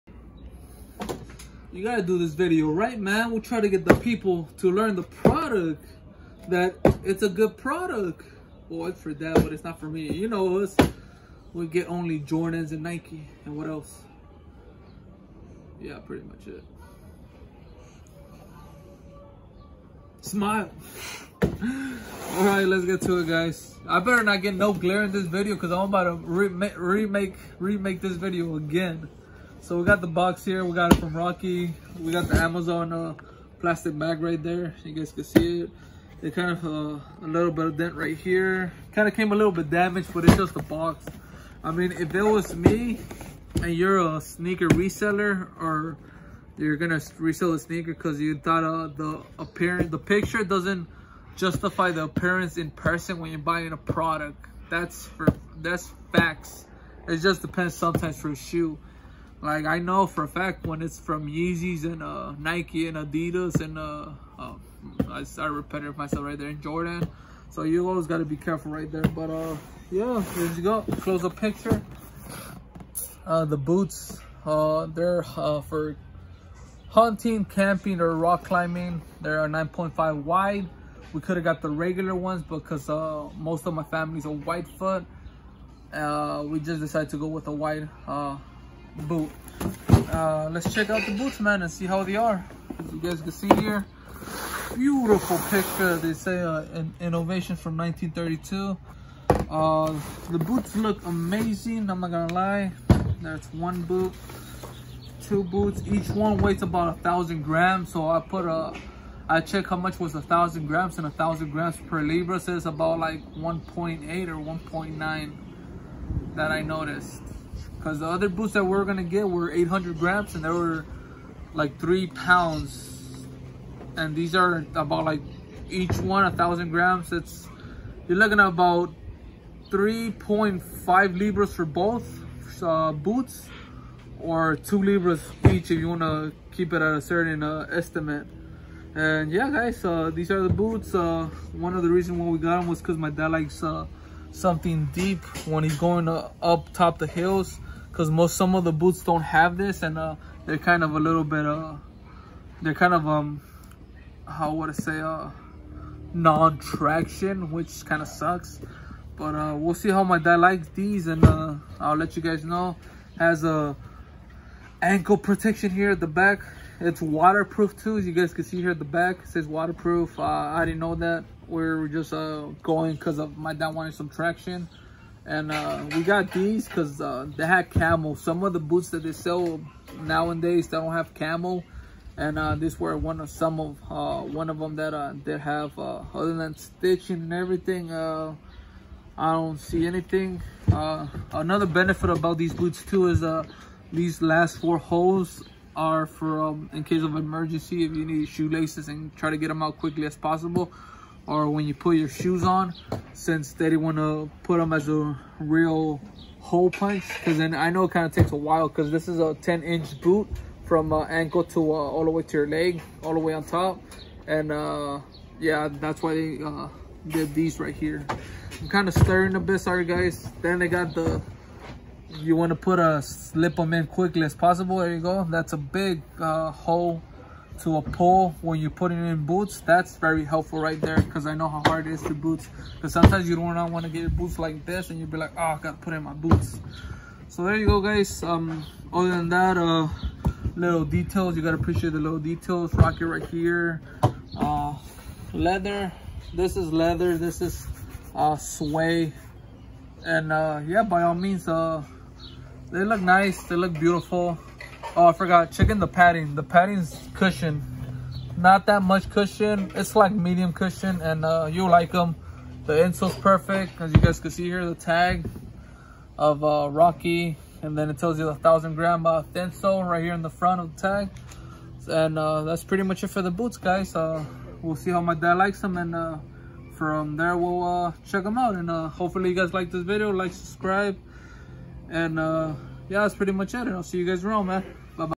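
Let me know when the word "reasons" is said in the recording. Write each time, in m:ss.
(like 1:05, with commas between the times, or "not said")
2:21.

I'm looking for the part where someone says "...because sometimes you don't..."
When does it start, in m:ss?
3:52.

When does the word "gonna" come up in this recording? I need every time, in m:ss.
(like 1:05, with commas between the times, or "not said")
0:46, 1:42, 1:58.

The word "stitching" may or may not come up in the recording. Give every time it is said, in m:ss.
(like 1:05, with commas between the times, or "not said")
3:06.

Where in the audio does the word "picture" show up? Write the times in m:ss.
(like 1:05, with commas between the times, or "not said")
0:49, 1:11, 1:35.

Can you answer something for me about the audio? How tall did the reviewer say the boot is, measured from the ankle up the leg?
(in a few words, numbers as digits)
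10 inch.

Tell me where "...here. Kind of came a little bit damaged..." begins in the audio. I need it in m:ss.
0:38.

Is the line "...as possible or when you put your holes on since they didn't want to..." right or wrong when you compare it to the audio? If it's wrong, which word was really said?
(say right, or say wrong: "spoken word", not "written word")
wrong: "shoes", not "holes".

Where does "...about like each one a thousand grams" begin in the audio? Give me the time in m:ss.
2:04.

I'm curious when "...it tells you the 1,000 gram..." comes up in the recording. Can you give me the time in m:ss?
4:27.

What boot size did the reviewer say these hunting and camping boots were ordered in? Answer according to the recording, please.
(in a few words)
9.5 wide.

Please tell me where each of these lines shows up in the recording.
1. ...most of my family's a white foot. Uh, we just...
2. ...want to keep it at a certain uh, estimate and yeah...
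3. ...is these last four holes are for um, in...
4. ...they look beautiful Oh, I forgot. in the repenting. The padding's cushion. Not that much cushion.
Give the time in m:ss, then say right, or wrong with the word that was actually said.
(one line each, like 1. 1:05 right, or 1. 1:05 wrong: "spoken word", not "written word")
1. 1:23 right
2. 2:15 right
3. 3:13 right
4. 4:13 wrong: "padding", not "repenting".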